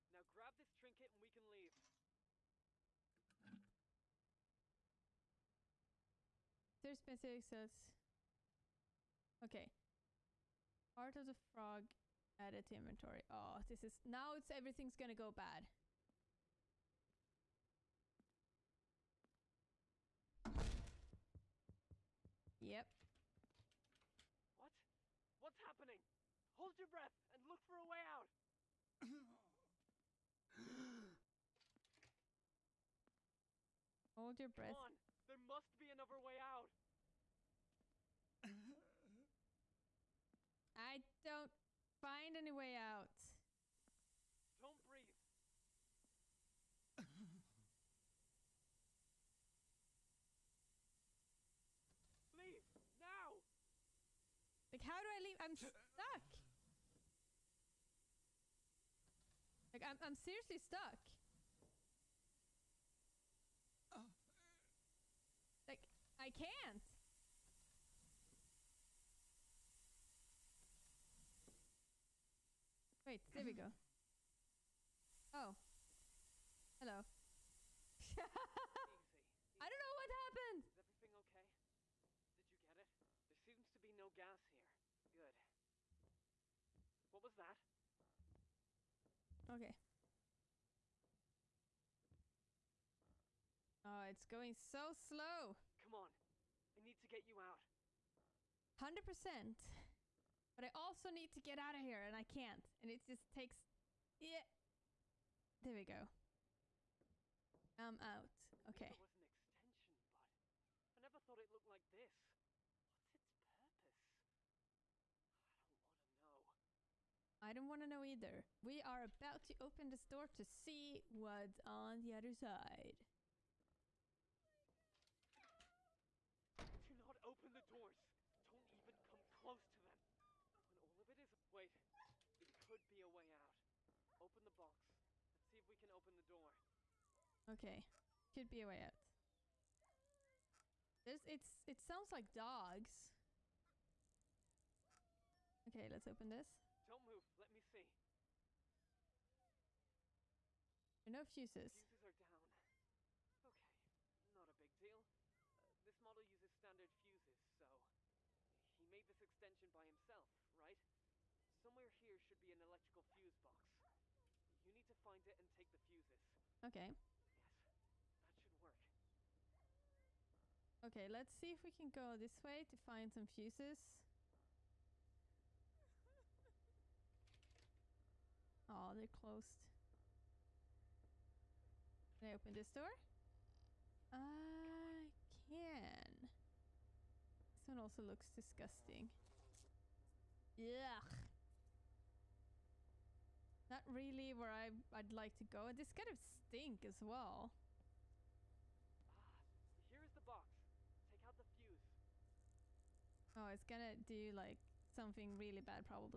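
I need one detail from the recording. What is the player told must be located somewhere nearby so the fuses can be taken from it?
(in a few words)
electrical fuse box.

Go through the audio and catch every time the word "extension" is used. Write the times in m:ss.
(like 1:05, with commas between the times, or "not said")
1:49, 2:39.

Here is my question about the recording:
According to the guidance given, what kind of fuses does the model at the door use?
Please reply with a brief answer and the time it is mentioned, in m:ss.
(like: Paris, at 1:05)
standard, at 2:36.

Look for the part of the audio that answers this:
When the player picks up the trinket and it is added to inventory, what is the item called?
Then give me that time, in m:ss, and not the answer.
0:10.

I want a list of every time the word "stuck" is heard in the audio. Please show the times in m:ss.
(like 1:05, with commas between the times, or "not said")
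0:55, 1:00.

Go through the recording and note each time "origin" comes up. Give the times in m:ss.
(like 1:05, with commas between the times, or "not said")
not said.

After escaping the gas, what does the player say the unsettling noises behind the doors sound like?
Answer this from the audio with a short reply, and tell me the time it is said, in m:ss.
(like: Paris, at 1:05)
dogs, at 2:22.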